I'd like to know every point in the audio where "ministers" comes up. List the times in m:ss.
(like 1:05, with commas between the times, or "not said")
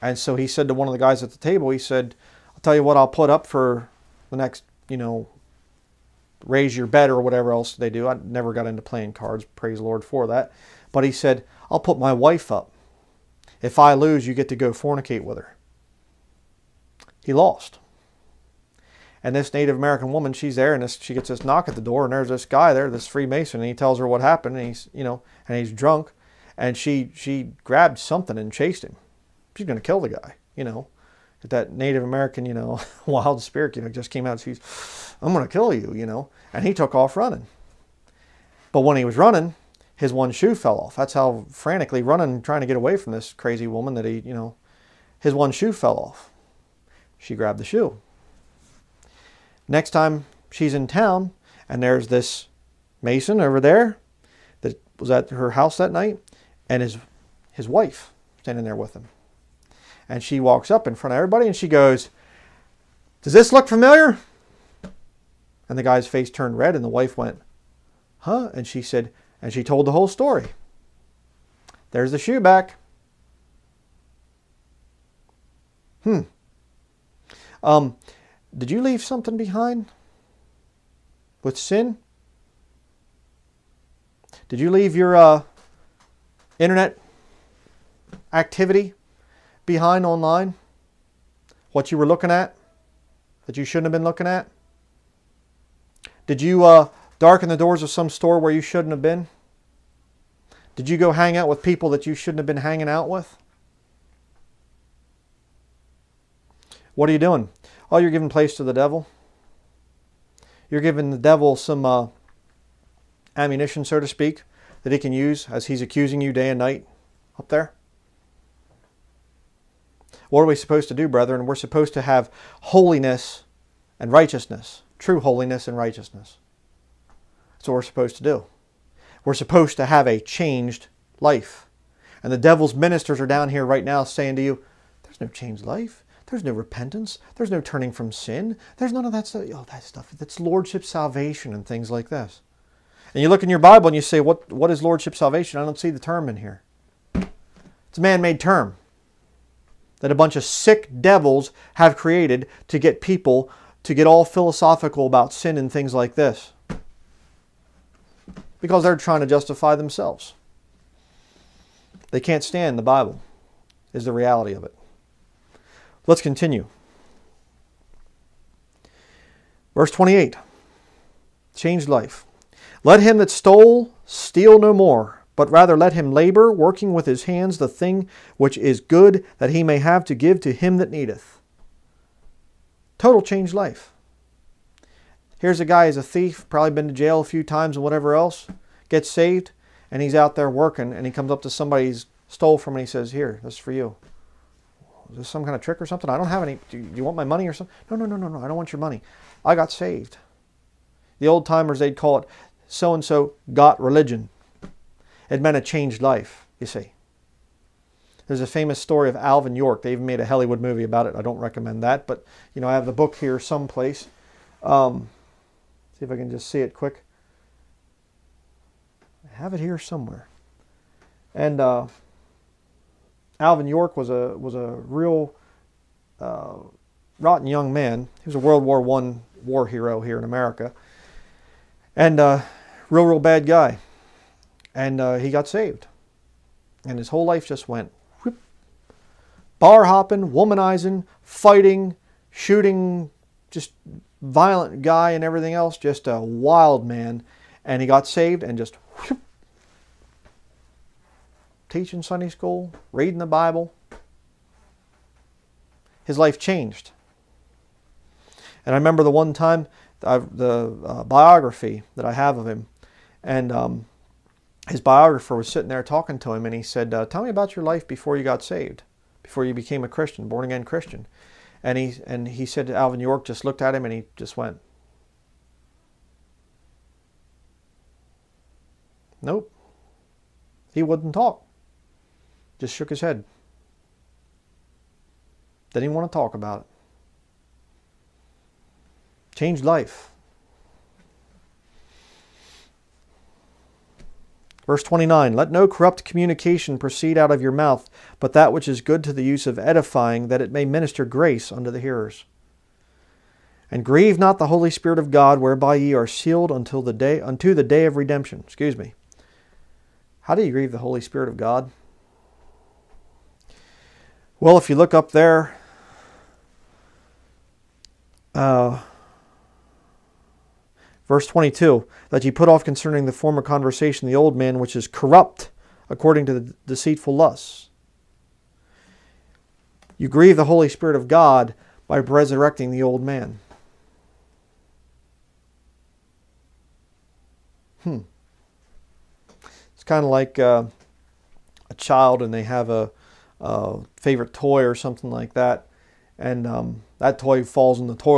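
2:12, 5:00.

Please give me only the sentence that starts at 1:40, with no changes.
Did you go hang out with people that you shouldn't have been hanging out with?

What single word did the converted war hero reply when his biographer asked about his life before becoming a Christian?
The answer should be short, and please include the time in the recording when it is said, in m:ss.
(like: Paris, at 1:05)
Nope, at 4:39.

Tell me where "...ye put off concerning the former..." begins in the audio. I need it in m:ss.
5:22.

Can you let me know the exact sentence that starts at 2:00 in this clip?
What are we supposed to do, brethren?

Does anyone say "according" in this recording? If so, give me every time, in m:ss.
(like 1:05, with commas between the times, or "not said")
5:25.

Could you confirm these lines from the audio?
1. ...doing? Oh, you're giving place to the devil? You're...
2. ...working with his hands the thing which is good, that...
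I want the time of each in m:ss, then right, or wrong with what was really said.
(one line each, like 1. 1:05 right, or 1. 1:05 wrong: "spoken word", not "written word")
1. 1:47 right
2. 2:56 right.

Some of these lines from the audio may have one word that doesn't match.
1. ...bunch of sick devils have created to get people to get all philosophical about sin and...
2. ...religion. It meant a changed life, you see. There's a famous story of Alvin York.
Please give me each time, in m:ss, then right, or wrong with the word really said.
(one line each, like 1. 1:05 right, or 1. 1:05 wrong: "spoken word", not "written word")
1. 2:30 right
2. 3:23 right.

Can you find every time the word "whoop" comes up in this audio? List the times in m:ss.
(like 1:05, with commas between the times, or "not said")
3:58, 4:08.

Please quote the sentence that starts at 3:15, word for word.
Is this some kind of trick or something?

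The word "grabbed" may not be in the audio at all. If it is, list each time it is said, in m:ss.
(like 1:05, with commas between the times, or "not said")
0:27, 0:47.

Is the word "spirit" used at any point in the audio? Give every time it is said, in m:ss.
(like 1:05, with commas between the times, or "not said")
0:33, 5:04, 5:10, 5:30.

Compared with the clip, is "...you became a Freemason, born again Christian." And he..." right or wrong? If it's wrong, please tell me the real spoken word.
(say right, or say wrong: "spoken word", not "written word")
wrong: "Christian", not "Freemason".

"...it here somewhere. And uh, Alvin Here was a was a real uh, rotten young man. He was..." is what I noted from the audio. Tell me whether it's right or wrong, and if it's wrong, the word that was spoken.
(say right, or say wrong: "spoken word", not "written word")
wrong: "York", not "Here".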